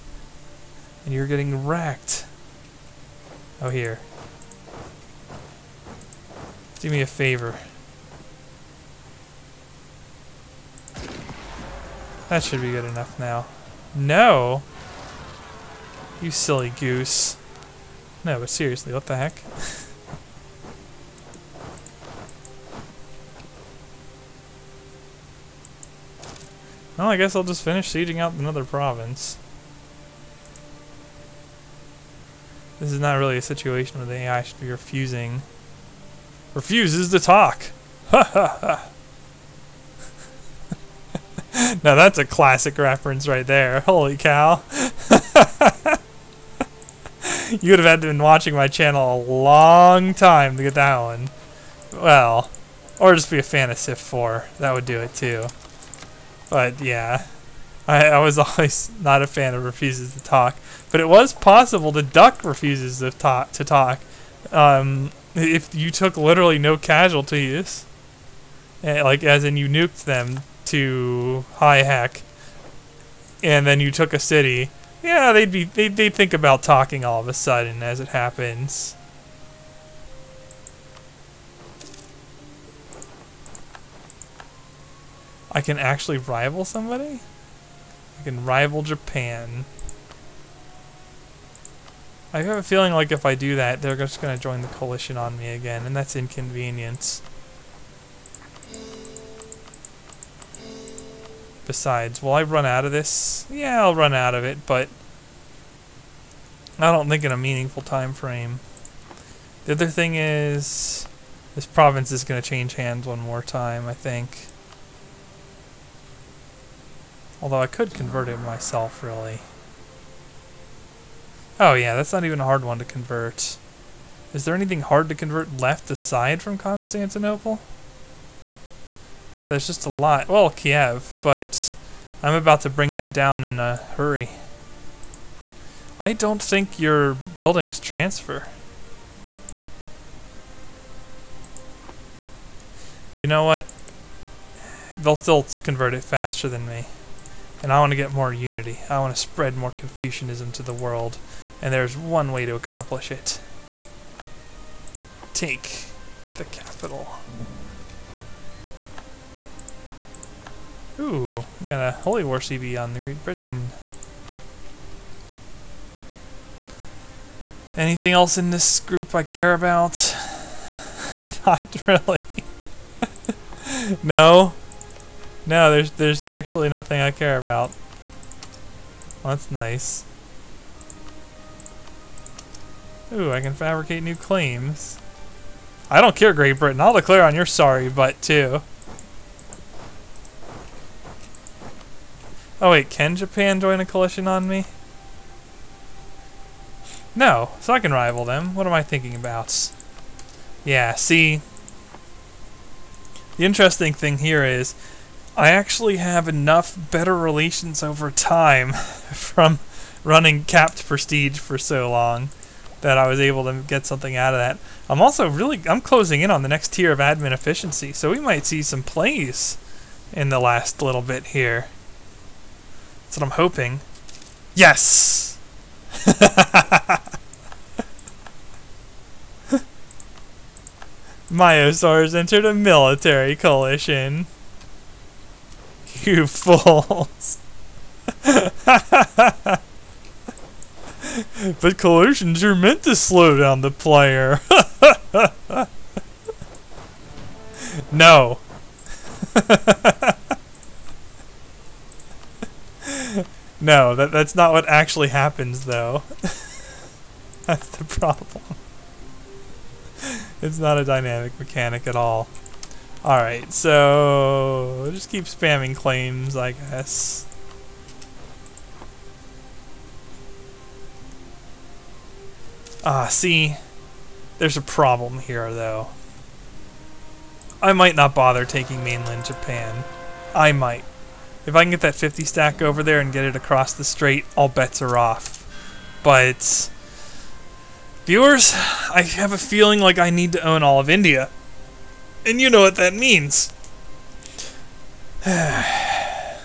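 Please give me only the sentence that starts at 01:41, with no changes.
Besides, will I run out of this?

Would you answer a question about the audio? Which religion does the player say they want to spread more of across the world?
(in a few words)
Confucianism.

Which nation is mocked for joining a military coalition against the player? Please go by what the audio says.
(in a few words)
Mysore.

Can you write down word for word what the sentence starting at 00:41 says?
now that's a classic reference right there.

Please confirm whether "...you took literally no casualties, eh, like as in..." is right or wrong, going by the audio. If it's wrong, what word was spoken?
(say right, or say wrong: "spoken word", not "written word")
right.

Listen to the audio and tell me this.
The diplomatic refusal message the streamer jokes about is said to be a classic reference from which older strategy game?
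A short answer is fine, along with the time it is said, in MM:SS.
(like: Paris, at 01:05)
Civ 4, at 00:53.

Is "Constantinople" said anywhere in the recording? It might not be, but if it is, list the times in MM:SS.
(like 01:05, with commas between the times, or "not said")
02:06.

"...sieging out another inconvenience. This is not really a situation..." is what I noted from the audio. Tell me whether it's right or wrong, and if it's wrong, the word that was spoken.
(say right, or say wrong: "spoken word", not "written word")
wrong: "province", not "inconvenience".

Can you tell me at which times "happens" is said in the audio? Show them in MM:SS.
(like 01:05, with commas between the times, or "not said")
01:18, 04:15.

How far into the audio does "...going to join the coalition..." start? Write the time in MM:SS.
01:34.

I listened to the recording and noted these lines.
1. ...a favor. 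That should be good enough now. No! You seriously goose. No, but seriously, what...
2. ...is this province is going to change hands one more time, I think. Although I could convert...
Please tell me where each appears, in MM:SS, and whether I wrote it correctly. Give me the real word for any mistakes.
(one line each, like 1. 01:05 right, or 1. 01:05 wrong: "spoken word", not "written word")
1. 00:06 wrong: "silly", not "seriously"
2. 01:50 right.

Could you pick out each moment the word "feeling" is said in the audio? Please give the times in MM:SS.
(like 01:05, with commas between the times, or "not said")
01:32, 04:49.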